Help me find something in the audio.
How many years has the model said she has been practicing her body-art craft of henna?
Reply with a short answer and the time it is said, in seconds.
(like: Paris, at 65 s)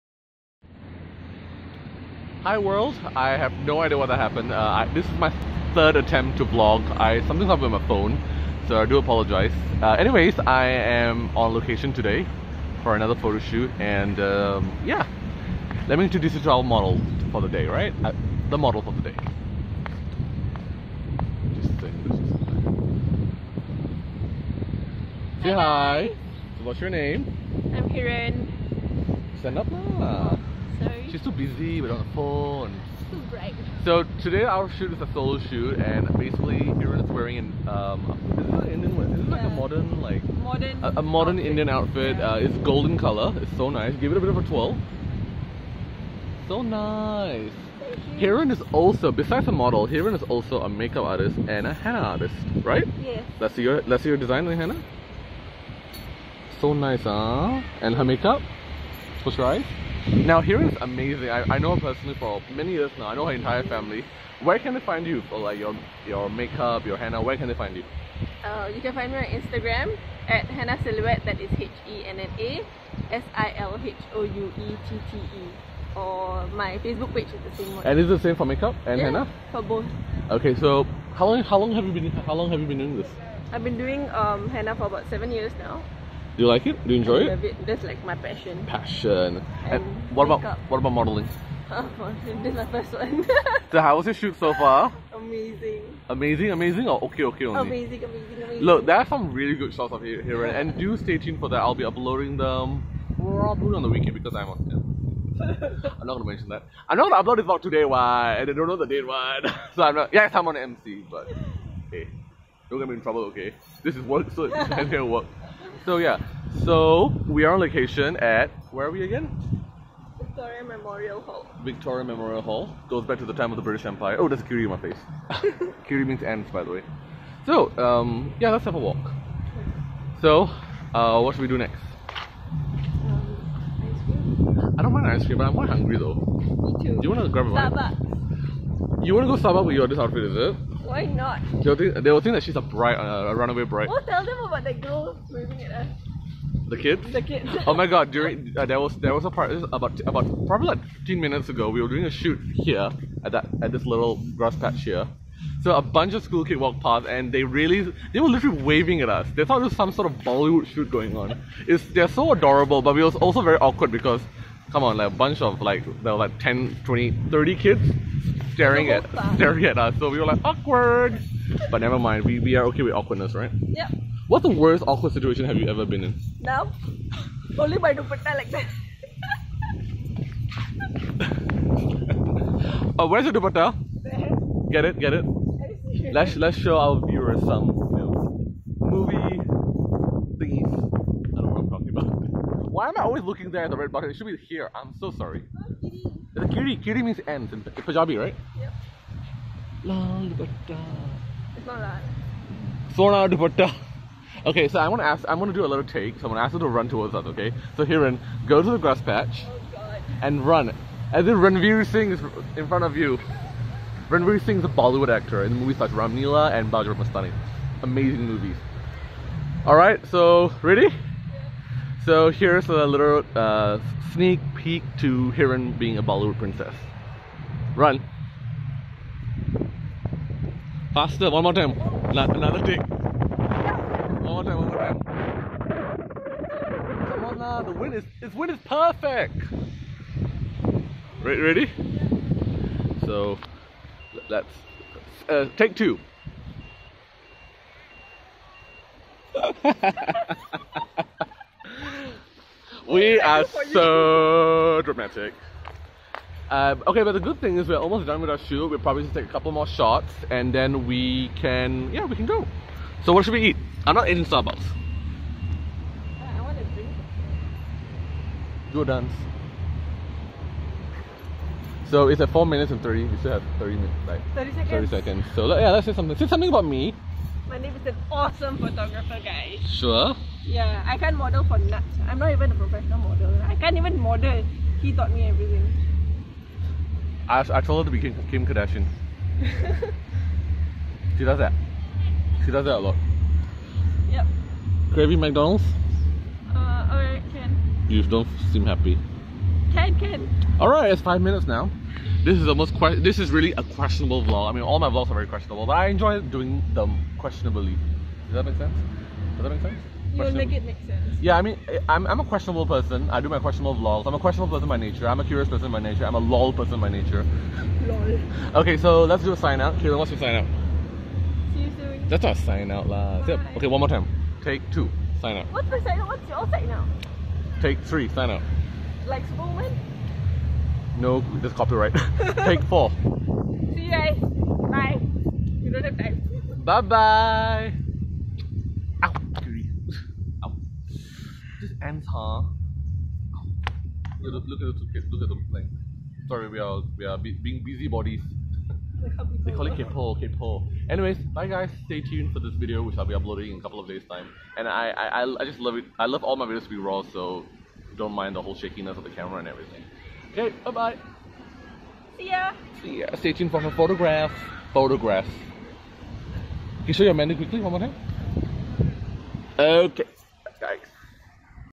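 7 years, at 85 s.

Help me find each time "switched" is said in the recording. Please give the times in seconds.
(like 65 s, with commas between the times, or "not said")
not said.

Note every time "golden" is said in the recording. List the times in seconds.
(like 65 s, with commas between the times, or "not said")
42 s.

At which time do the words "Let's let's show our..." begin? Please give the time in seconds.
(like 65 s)
186 s.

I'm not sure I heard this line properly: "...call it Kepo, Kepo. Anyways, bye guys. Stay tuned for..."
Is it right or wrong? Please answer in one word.
right.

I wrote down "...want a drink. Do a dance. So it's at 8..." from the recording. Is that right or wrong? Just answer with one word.
wrong.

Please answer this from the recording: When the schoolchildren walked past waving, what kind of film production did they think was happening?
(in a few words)
Bollywood shoot.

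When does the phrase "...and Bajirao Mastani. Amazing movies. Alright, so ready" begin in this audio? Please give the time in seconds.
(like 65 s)
216 s.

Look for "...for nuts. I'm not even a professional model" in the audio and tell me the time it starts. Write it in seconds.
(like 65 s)
281 s.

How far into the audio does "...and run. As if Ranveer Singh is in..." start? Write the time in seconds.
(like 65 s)
210 s.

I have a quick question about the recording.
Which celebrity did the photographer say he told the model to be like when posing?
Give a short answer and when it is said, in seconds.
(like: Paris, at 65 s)
Kim Kardashian, at 288 s.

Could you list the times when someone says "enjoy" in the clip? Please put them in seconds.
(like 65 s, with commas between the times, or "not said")
87 s, 305 s.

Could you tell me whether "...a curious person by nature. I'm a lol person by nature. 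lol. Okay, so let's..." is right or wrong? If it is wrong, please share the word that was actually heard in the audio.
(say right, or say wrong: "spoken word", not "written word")
right.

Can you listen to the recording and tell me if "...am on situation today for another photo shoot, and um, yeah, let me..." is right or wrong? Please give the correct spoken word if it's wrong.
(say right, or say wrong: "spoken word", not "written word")
wrong: "location", not "situation".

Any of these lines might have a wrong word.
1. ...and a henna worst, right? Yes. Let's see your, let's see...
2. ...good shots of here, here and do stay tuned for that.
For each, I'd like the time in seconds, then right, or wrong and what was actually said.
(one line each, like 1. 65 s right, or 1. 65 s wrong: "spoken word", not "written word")
1. 51 s wrong: "artist", not "worst"
2. 99 s right.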